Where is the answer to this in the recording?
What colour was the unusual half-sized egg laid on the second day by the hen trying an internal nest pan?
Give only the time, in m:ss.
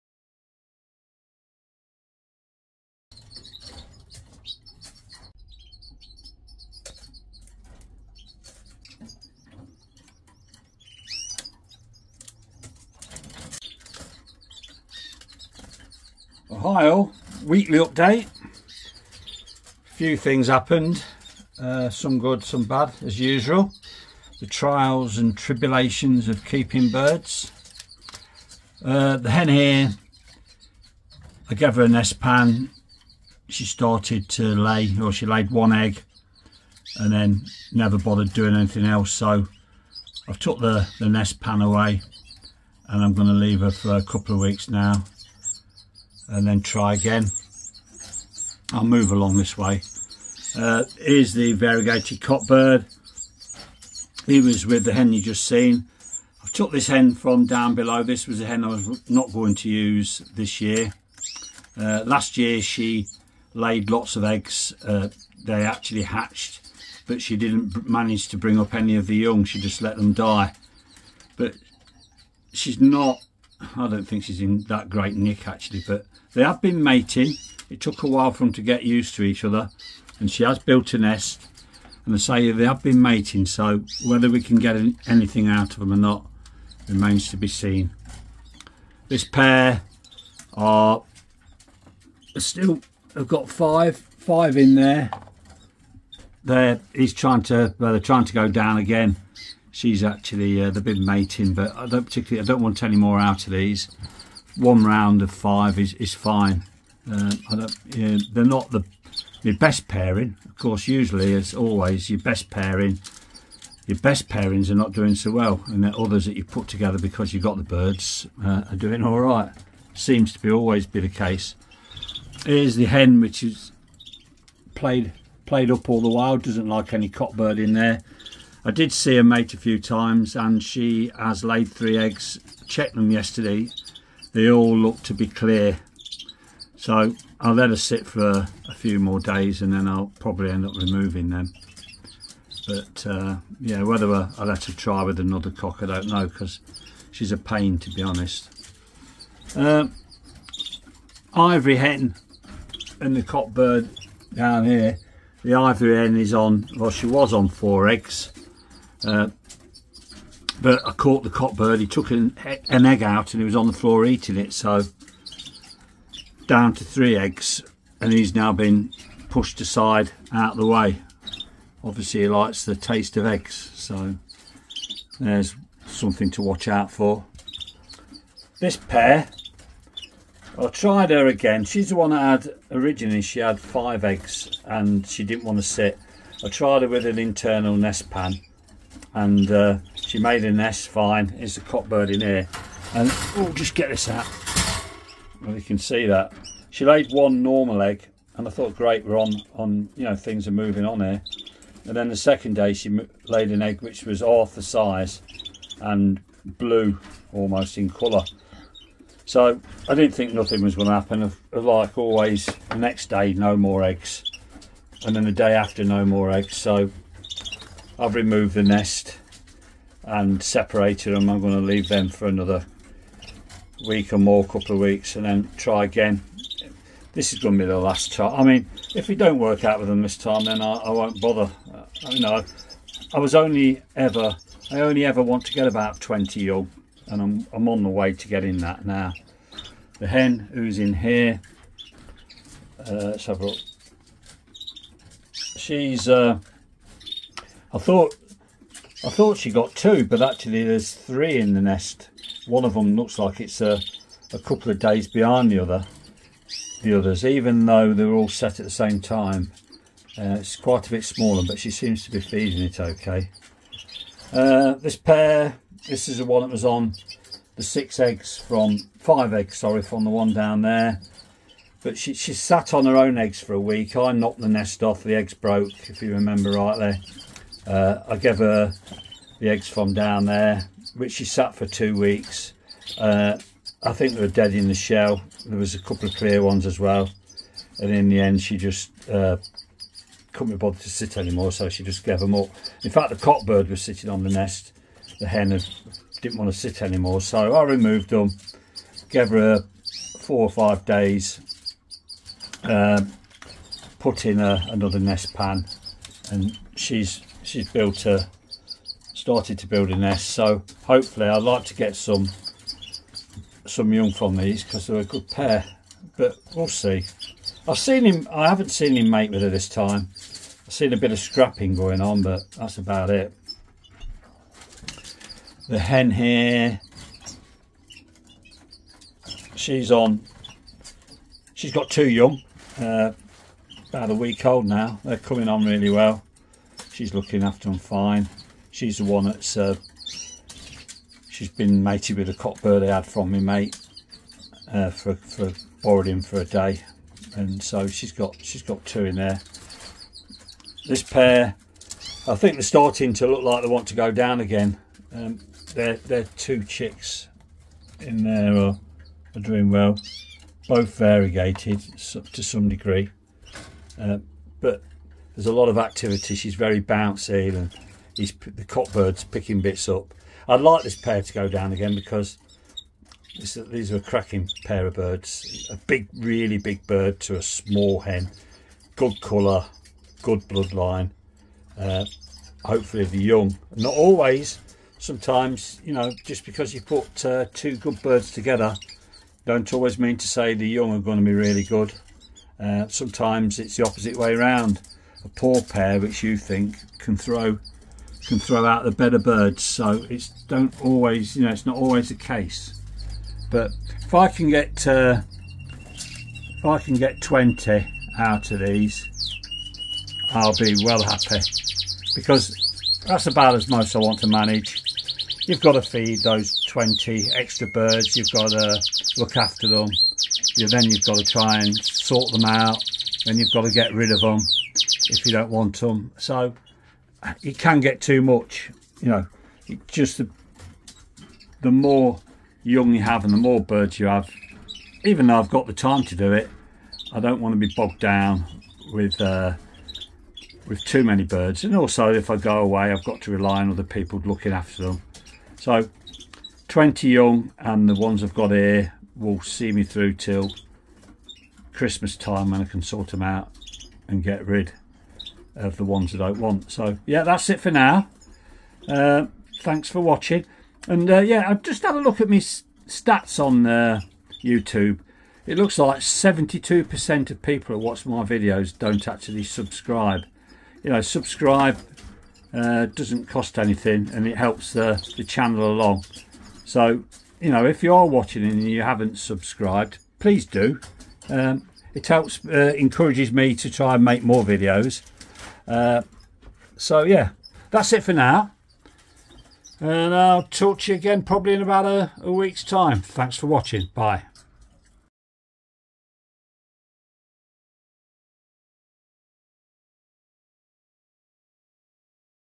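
3:26.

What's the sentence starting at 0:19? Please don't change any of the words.
A few things happened, uh, some good, some bad, as usual.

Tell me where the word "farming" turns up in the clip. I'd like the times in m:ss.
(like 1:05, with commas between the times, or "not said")
not said.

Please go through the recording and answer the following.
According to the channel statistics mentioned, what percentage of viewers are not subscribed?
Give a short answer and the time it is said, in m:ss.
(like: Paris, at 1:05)
72%, at 7:45.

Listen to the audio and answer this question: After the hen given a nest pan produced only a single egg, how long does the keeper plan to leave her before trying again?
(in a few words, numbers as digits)
a couple of weeks.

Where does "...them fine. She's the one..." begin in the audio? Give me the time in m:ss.
5:37.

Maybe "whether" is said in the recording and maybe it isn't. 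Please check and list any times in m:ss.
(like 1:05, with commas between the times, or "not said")
1:24, 2:23.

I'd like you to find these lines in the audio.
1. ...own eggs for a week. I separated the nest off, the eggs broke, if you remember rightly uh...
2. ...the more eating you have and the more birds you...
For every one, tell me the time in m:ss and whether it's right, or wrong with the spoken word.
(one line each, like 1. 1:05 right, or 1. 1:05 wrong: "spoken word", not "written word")
1. 4:32 wrong: "knocked", not "separated"
2. 7:11 wrong: "young", not "eating".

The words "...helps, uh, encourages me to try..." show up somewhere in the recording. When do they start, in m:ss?
8:02.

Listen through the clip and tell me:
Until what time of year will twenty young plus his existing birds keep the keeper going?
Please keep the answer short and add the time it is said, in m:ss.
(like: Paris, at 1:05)
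Christmas, at 7:31.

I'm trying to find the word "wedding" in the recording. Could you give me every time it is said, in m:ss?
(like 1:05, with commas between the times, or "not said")
not said.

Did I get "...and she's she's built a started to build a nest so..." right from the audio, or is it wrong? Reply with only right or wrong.
right.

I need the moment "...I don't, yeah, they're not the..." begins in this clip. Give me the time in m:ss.
1:47.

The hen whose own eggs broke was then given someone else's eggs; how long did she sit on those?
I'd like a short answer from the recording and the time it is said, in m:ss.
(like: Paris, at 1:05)
2 weeks, at 4:41.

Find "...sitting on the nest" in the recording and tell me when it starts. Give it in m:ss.
4:53.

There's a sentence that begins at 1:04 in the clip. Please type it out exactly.
Uh, they actually hatched, but she didn't manage to bring up any of the young.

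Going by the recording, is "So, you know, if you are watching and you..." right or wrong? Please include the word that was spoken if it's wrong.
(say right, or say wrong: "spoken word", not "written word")
right.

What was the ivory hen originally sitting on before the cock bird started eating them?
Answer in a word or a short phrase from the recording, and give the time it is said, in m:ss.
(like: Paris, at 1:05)
4 eggs, at 2:37.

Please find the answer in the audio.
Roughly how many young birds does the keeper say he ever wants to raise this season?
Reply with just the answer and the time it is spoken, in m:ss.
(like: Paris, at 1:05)
20, at 3:55.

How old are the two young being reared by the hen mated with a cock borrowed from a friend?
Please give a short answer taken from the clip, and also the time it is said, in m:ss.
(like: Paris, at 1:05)
about a week, at 5:33.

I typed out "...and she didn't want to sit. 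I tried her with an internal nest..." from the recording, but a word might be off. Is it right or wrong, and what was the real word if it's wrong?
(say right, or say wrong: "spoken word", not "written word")
right.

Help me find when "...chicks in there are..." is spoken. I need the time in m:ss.
5:56.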